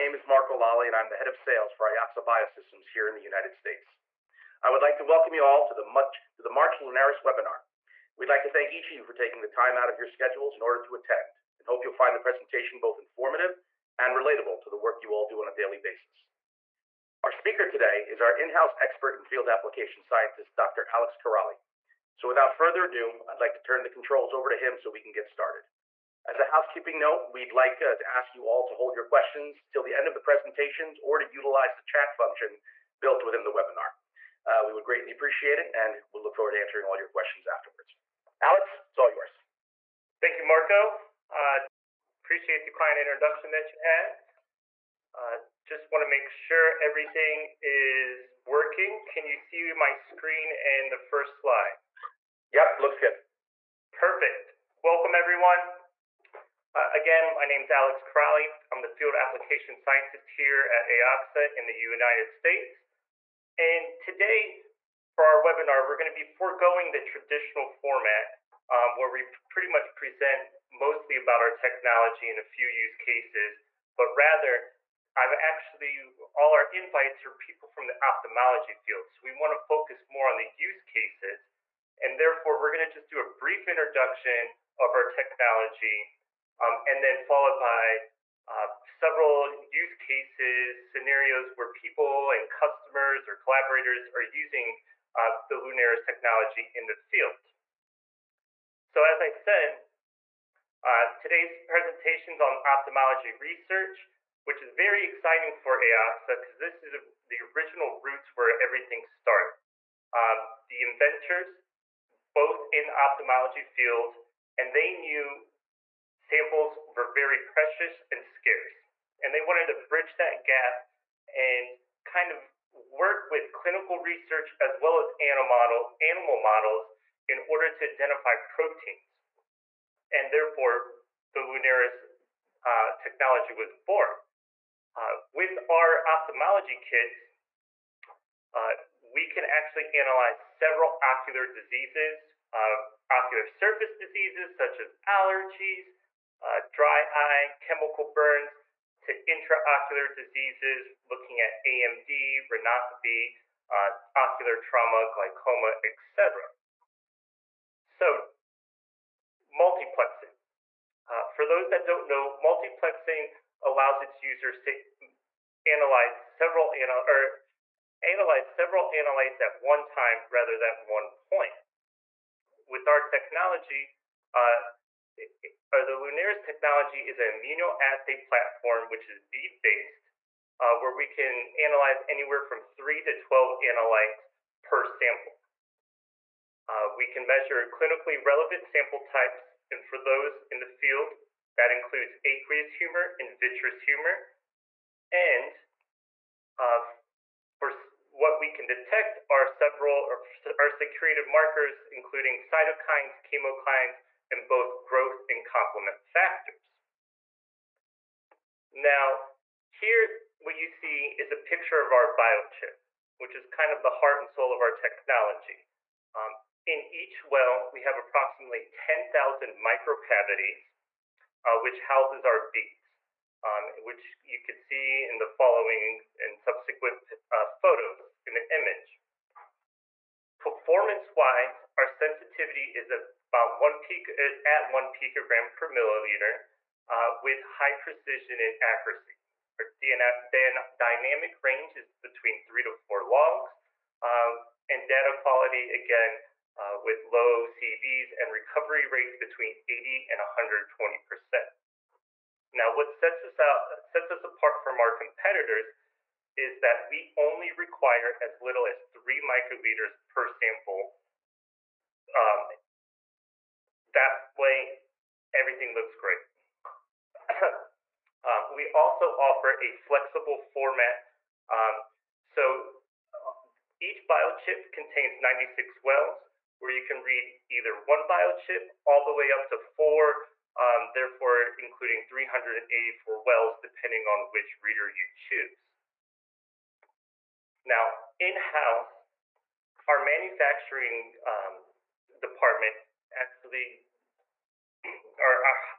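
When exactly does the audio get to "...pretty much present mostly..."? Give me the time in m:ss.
1:09.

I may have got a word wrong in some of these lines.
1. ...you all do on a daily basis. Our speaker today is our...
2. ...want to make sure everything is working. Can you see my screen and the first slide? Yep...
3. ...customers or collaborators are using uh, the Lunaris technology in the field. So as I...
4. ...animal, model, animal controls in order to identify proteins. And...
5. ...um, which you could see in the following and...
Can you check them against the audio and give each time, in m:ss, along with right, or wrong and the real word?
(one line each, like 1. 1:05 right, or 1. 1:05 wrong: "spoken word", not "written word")
1. 0:15 right
2. 0:45 right
3. 1:32 right
4. 2:05 wrong: "models", not "controls"
5. 3:43 right.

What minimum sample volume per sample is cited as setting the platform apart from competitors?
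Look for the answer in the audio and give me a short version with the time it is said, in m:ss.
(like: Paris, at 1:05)
3 microliters, at 4:18.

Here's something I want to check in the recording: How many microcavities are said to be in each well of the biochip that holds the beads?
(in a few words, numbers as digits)
10,000.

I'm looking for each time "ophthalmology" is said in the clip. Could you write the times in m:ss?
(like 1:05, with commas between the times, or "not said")
1:18, 1:42, 1:52, 2:16.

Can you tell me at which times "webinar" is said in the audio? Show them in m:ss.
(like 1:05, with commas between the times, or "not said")
0:07, 0:33, 1:05.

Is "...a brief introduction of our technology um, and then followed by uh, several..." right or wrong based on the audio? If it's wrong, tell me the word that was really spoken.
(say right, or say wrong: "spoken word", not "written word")
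right.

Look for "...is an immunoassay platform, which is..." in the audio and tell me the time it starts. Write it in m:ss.
2:57.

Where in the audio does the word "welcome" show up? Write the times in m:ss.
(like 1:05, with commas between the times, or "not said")
0:05, 0:54.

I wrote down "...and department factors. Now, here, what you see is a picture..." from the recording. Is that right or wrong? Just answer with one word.
wrong.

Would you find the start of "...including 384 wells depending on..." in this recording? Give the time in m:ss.
4:41.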